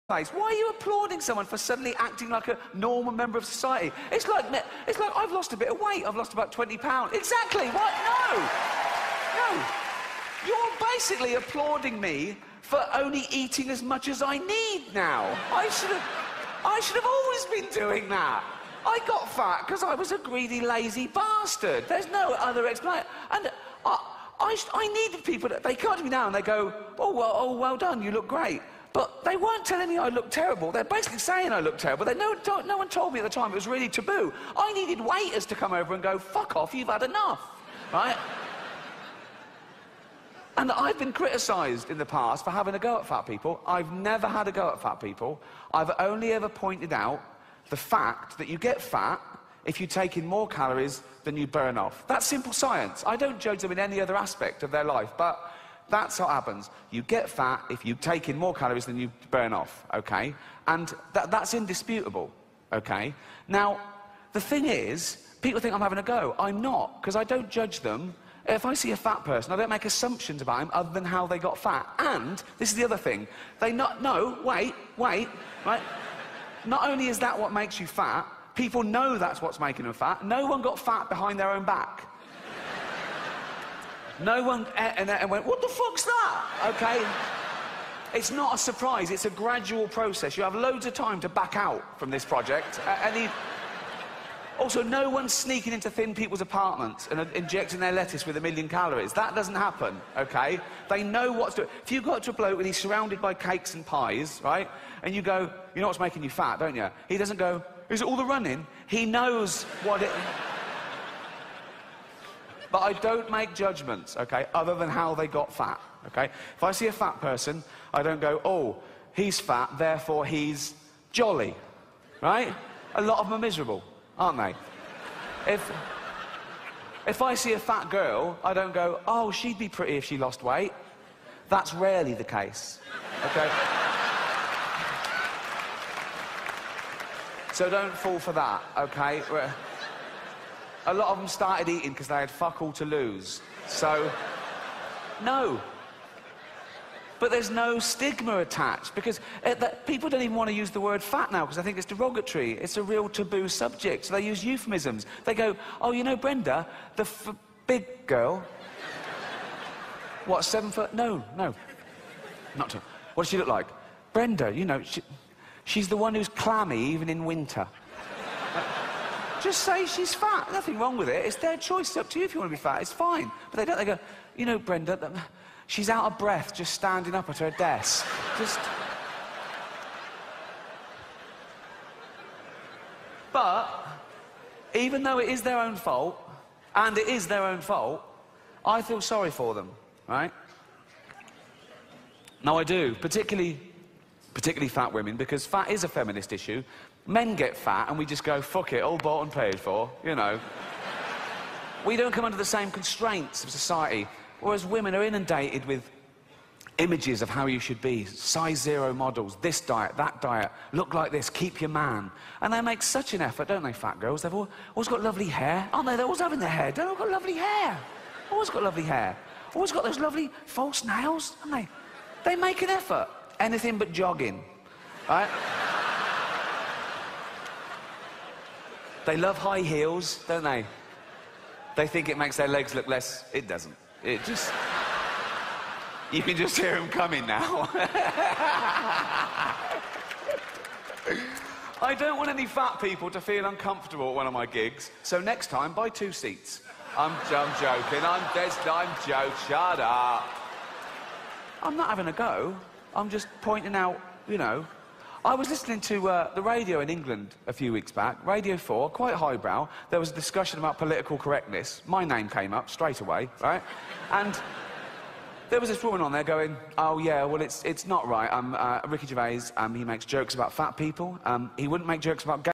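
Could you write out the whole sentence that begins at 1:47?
He doesn't go, is it all the running?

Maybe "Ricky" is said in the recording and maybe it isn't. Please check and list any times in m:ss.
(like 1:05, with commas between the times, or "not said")
4:28.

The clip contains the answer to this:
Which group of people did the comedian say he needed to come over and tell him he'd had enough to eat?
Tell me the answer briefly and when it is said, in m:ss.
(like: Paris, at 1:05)
Waiters, at 0:34.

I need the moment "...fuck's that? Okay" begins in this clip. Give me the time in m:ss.
1:25.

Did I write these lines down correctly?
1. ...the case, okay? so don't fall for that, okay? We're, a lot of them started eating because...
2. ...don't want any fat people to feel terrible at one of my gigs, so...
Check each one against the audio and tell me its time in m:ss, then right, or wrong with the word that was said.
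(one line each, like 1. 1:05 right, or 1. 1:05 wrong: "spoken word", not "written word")
1. 2:12 right
2. 4:01 wrong: "uncomfortable", not "terrible".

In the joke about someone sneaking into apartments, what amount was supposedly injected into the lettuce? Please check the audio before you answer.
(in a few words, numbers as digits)
A million calories.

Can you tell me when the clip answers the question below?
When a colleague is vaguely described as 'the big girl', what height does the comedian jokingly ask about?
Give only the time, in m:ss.
2:40.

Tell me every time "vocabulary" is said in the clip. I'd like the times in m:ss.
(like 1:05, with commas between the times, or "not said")
not said.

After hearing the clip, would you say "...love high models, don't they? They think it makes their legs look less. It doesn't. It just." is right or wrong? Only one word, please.
wrong.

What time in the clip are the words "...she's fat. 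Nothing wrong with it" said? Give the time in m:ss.
2:49.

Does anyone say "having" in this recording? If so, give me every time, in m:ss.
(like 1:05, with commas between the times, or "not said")
0:42, 1:05, 3:36, 4:11.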